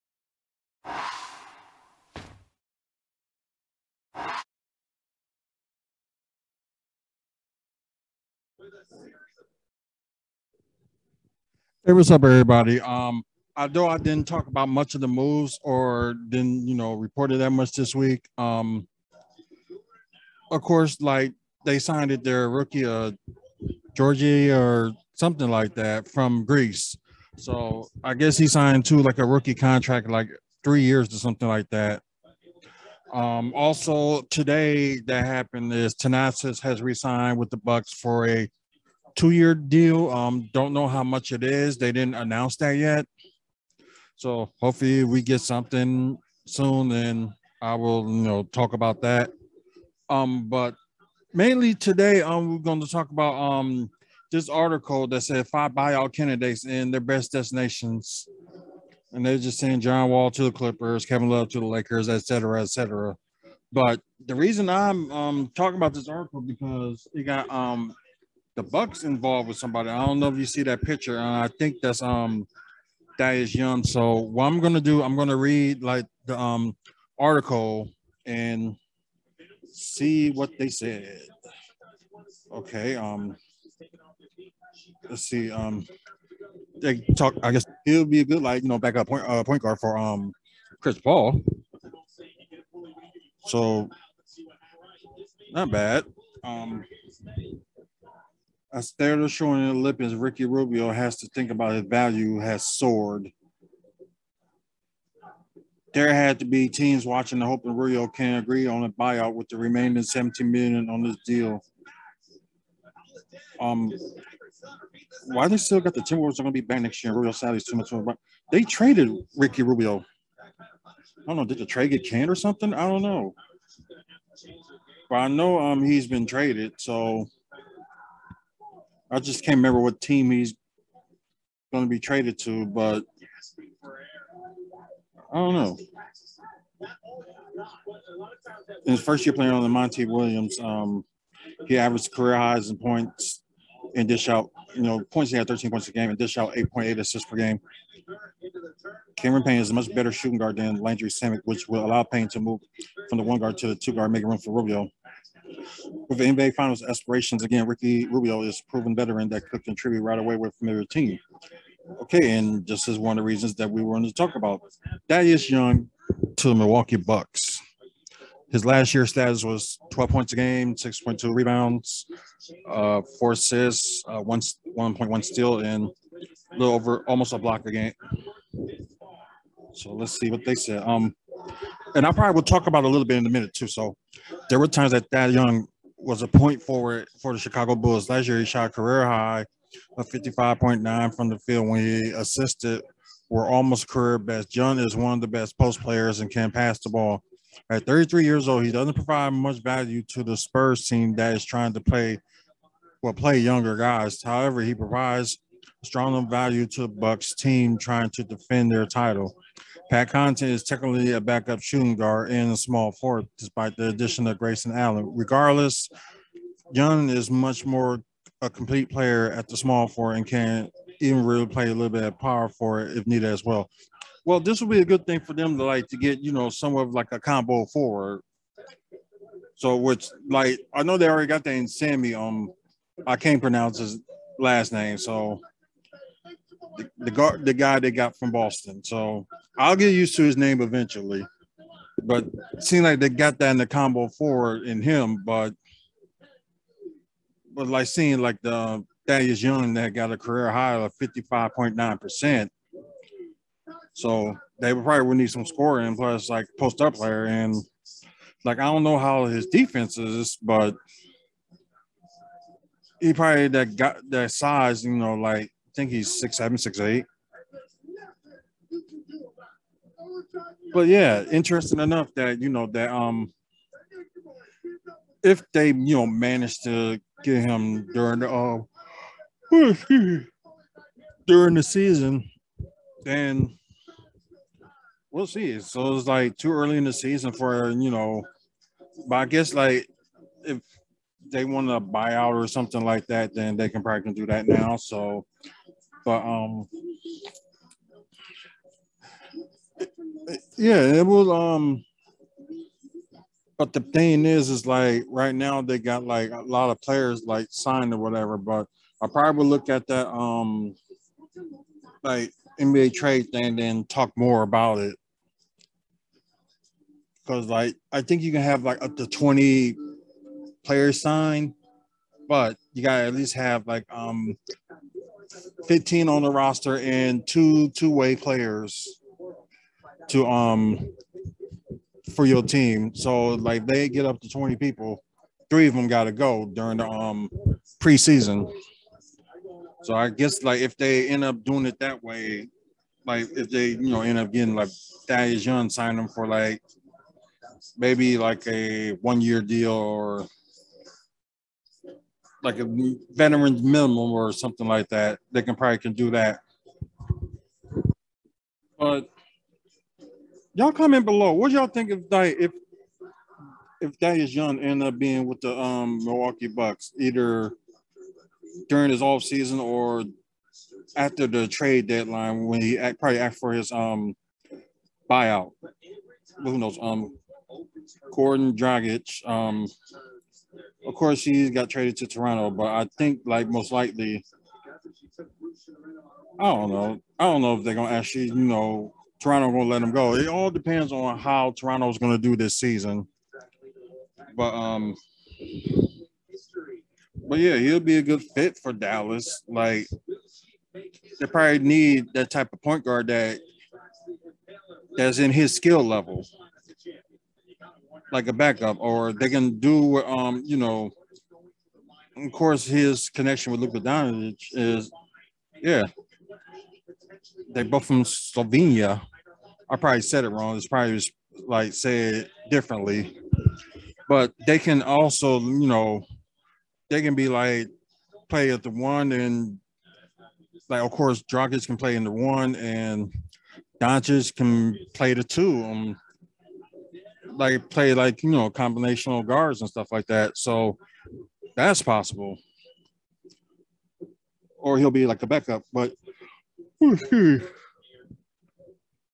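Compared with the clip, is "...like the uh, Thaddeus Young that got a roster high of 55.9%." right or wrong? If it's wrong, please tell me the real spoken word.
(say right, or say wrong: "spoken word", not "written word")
wrong: "career", not "roster".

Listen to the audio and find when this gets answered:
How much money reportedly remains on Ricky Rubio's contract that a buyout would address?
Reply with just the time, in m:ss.
1:50.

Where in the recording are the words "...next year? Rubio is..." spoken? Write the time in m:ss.
1:56.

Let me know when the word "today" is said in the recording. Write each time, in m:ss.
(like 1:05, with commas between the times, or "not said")
0:34, 0:51.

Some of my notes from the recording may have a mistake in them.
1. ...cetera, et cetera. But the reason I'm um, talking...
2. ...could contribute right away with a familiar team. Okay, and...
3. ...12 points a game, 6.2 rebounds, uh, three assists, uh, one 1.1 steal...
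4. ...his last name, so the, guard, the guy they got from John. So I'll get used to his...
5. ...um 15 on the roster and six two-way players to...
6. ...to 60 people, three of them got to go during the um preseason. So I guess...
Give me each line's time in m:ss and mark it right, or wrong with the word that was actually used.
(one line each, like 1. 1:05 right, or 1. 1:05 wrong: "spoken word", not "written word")
1. 1:02 right
2. 2:39 right
3. 2:49 wrong: "four", not "three"
4. 3:53 wrong: "Boston", not "John"
5. 5:23 wrong: "two", not "six"
6. 5:34 wrong: "20", not "60".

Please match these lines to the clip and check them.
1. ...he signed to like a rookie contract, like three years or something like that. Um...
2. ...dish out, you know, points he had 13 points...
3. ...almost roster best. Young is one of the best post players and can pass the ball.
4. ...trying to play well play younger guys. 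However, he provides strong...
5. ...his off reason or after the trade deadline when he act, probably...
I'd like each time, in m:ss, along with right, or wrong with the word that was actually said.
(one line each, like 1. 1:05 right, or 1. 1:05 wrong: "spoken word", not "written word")
1. 0:28 right
2. 2:24 right
3. 3:13 wrong: "career", not "roster"
4. 3:21 right
5. 6:08 wrong: "season", not "reason".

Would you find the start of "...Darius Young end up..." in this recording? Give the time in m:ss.
6:03.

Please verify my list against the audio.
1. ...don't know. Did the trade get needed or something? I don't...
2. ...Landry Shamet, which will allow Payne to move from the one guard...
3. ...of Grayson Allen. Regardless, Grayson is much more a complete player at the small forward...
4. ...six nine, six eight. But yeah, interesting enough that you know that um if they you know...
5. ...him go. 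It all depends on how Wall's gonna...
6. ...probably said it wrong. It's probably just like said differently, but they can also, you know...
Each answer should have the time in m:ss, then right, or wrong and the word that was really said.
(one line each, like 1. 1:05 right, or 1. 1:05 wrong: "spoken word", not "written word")
1. 2:01 wrong: "canned", not "needed"
2. 2:30 right
3. 3:34 wrong: "Young", not "Grayson"
4. 4:26 wrong: "seven", not "nine"
5. 6:29 wrong: "Toronto", not "Wall"
6. 6:59 right.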